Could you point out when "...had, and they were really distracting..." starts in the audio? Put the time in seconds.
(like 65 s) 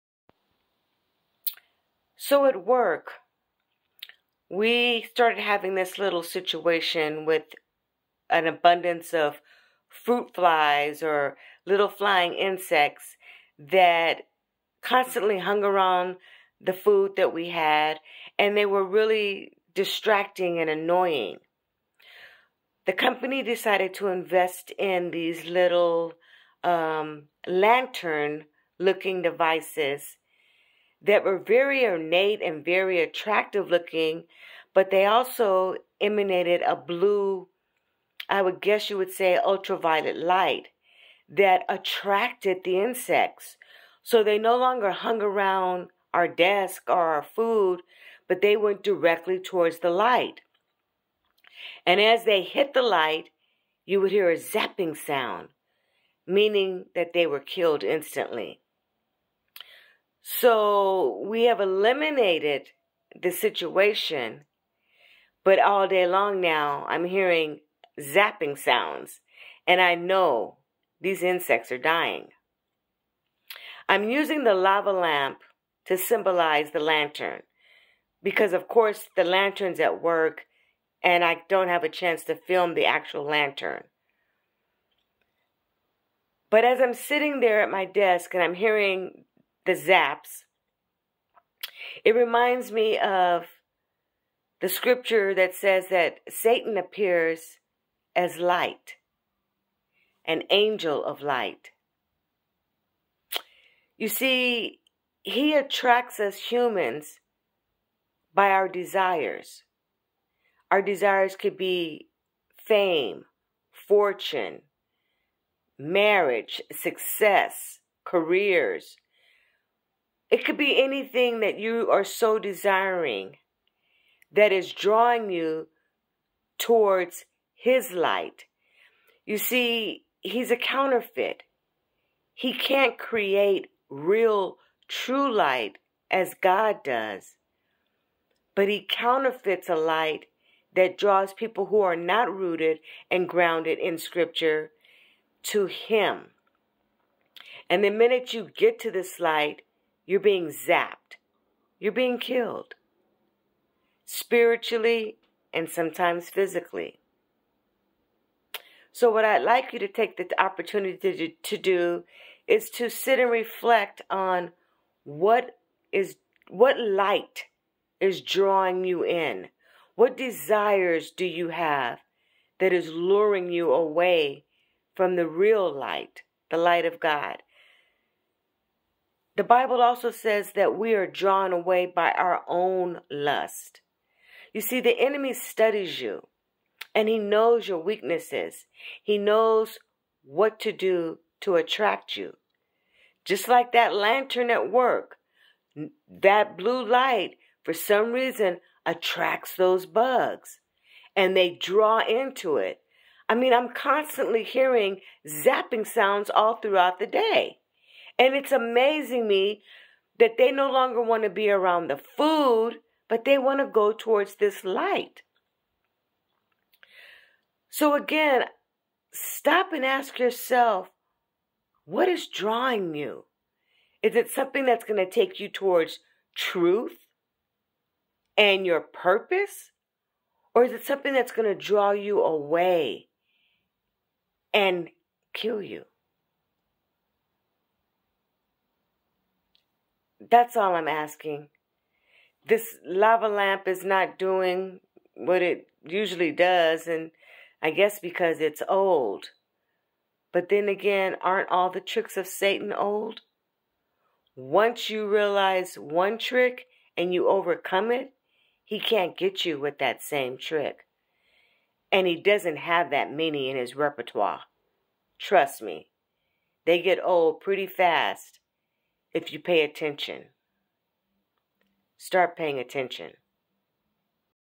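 17 s.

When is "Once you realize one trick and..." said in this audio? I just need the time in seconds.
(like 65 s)
254 s.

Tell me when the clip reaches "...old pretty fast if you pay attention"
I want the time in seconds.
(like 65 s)
267 s.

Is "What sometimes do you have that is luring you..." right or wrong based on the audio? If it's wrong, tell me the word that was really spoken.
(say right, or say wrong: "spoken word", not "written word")
wrong: "desires", not "sometimes".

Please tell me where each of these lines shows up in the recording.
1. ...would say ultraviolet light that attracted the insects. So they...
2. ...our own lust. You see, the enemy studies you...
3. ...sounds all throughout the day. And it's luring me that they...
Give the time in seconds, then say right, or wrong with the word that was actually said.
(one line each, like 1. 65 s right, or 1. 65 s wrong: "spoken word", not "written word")
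1. 38 s right
2. 182 s right
3. 205 s wrong: "amazing", not "luring".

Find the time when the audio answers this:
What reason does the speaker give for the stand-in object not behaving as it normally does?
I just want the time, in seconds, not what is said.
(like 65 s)
248 s.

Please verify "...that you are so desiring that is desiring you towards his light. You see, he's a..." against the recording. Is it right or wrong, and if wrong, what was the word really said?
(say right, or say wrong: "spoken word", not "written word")
wrong: "drawing", not "desiring".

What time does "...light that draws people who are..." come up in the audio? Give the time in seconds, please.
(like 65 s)
139 s.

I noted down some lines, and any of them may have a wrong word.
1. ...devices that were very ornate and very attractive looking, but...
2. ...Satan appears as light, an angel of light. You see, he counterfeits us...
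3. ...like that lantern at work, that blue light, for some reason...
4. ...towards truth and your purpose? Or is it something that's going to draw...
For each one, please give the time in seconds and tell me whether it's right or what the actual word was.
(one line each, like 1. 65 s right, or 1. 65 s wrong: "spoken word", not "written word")
1. 29 s right
2. 96 s wrong: "attracts", not "counterfeits"
3. 193 s right
4. 225 s right.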